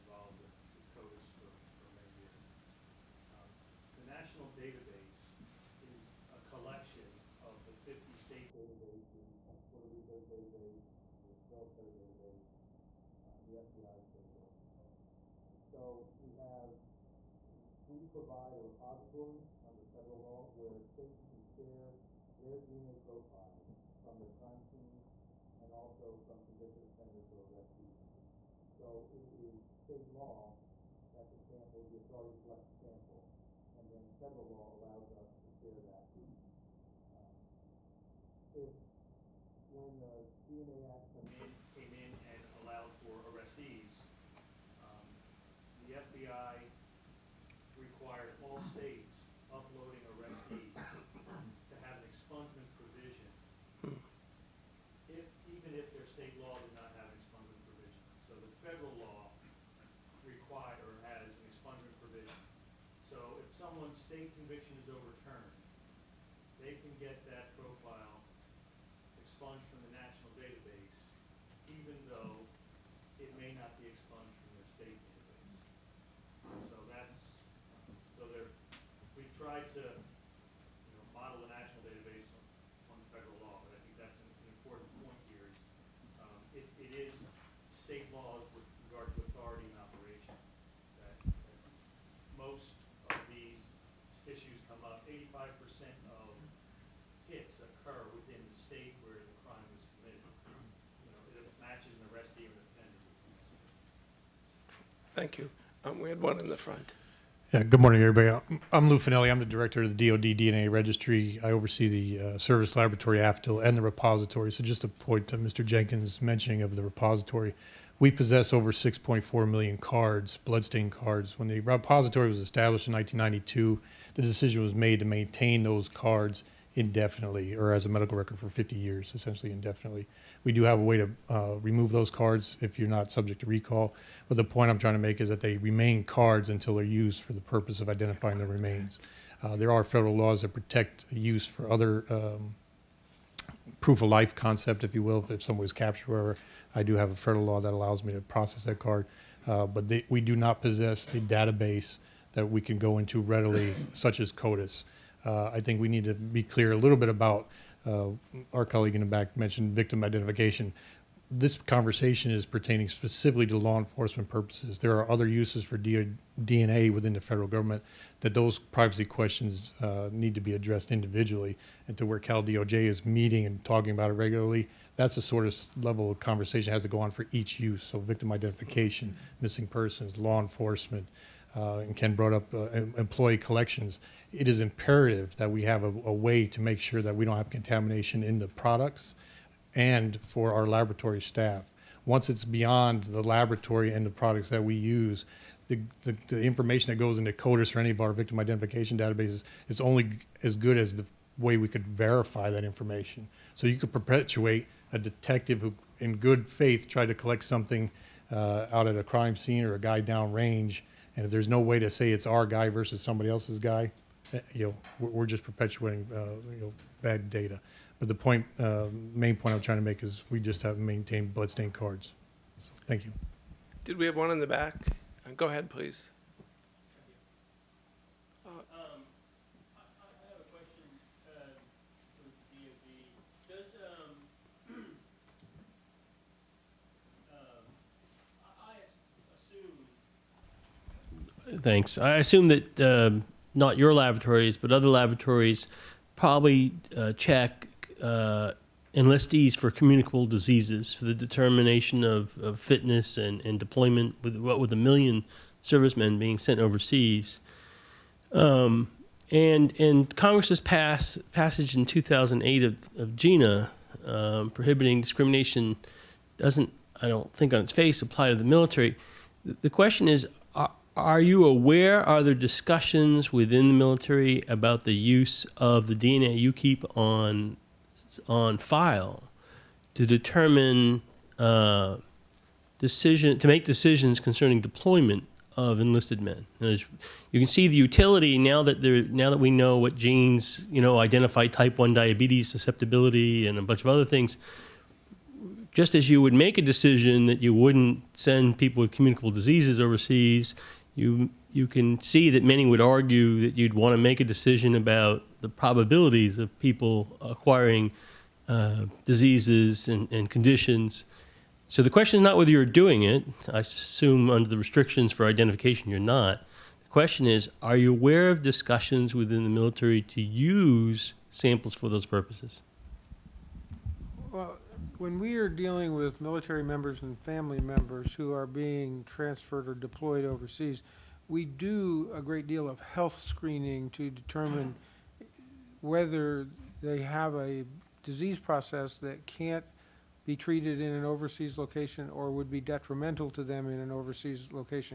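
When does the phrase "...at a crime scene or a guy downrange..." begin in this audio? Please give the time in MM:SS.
03:28.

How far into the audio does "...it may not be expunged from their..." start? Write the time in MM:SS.
01:13.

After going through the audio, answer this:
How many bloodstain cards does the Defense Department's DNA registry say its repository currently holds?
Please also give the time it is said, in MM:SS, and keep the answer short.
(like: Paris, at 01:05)
6.4 million, at 01:58.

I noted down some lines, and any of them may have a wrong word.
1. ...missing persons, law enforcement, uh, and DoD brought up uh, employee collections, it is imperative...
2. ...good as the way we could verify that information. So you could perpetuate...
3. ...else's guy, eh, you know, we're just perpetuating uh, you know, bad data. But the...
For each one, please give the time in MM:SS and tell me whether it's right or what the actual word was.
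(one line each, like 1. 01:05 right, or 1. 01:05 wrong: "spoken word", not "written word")
1. 02:59 wrong: "Ken", not "DoD"
2. 03:20 right
3. 03:33 right.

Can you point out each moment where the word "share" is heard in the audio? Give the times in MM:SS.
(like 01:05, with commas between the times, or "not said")
00:21, 00:35.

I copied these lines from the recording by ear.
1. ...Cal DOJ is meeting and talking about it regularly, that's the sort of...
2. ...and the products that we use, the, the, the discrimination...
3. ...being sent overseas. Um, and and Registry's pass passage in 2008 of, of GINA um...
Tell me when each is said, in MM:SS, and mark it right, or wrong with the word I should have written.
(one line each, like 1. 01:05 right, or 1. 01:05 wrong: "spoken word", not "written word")
1. 02:52 right
2. 03:13 wrong: "information", not "discrimination"
3. 04:16 wrong: "Congress", not "Registry".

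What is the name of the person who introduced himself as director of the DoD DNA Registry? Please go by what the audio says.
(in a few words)
Lou Finelli.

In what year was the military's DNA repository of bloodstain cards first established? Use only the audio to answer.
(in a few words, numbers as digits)
1992.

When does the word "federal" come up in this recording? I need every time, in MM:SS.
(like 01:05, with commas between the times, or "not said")
00:19, 00:34, 01:23, 02:19, 02:27, 02:47.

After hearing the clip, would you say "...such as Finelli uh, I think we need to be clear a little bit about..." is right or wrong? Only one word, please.
wrong.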